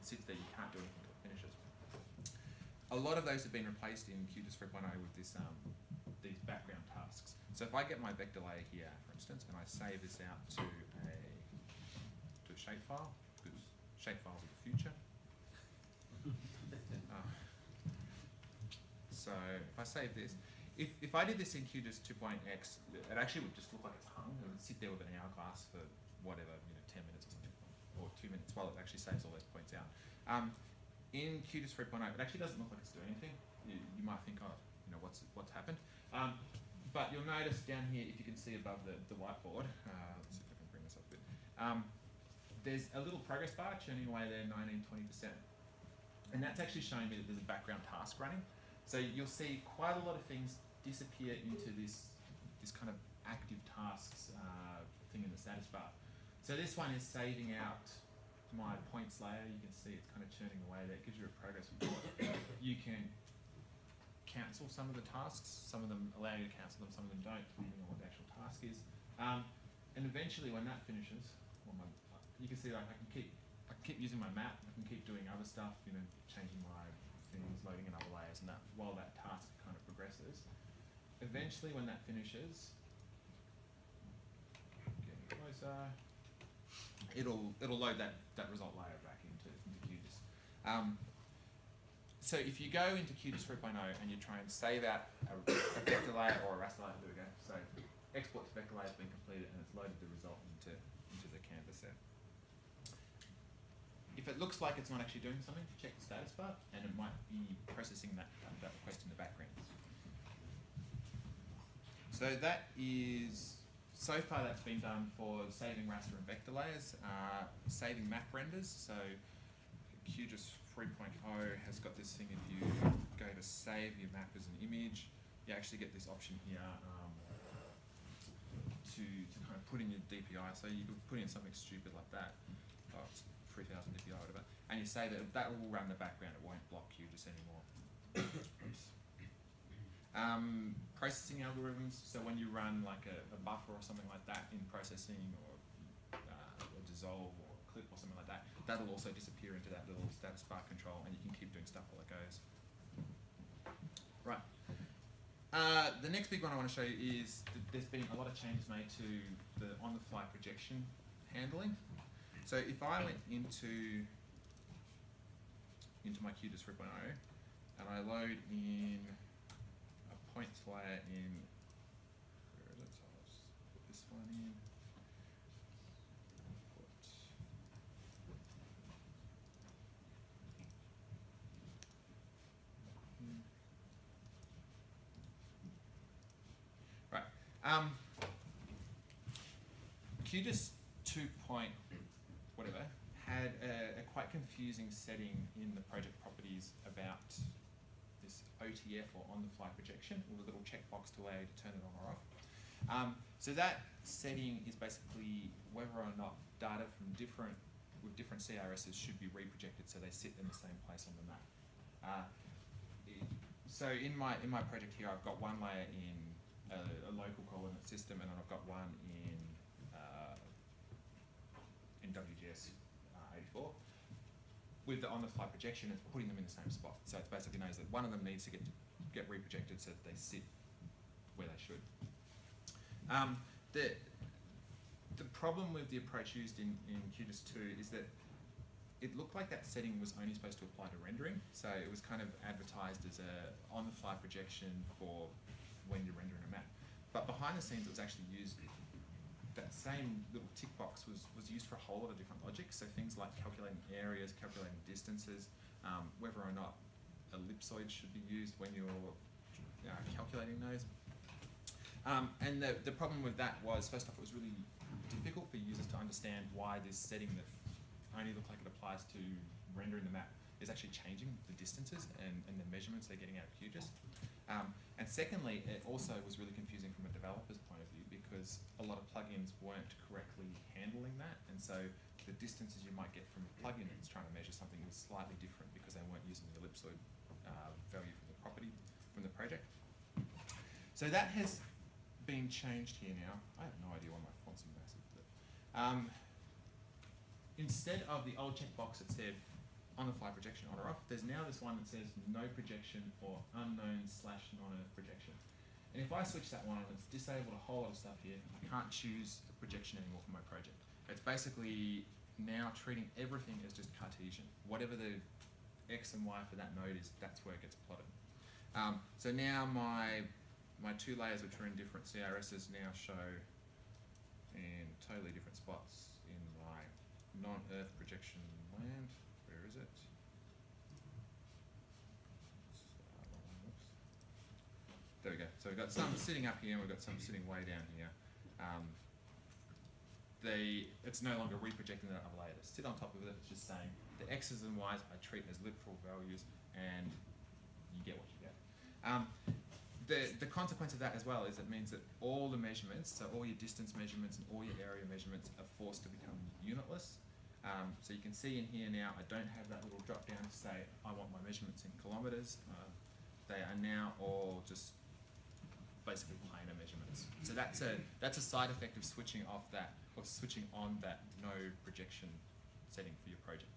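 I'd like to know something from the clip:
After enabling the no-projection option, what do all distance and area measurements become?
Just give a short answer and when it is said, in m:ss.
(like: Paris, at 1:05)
Unitless, at 5:56.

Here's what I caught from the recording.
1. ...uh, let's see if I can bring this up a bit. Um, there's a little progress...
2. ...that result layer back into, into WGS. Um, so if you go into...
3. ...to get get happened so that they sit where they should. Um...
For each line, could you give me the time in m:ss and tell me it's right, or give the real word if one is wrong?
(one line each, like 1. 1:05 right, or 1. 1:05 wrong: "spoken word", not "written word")
1. 0:39 right
2. 1:28 wrong: "QGIS", not "WGS"
3. 3:48 wrong: "reprojected", not "happened".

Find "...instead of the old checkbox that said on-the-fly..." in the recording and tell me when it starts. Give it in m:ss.
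4:57.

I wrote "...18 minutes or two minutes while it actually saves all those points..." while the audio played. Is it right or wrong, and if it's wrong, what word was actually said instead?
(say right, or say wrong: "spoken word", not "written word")
wrong: "10", not "18".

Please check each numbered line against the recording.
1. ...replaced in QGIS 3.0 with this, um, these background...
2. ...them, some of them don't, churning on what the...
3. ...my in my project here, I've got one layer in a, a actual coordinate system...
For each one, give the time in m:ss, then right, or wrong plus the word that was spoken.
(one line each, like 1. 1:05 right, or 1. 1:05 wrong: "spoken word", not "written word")
1. 0:03 right
2. 1:06 wrong: "depending", not "churning"
3. 3:34 wrong: "local", not "actual".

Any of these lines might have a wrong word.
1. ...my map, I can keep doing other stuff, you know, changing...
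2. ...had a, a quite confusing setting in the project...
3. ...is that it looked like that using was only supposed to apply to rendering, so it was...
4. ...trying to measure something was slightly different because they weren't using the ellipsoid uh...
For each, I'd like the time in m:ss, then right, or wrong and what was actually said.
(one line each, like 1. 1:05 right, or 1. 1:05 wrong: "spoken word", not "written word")
1. 1:14 right
2. 3:13 right
3. 3:57 wrong: "setting", not "using"
4. 4:44 right.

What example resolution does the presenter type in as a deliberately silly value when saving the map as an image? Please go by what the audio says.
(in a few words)
3000 DPI.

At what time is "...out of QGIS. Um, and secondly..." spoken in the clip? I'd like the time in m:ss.
4:33.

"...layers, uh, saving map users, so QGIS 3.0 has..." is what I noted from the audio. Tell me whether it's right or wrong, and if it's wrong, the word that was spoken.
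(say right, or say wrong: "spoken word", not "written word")
wrong: "renders", not "users".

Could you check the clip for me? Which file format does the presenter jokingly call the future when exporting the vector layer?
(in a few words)
Shapefiles.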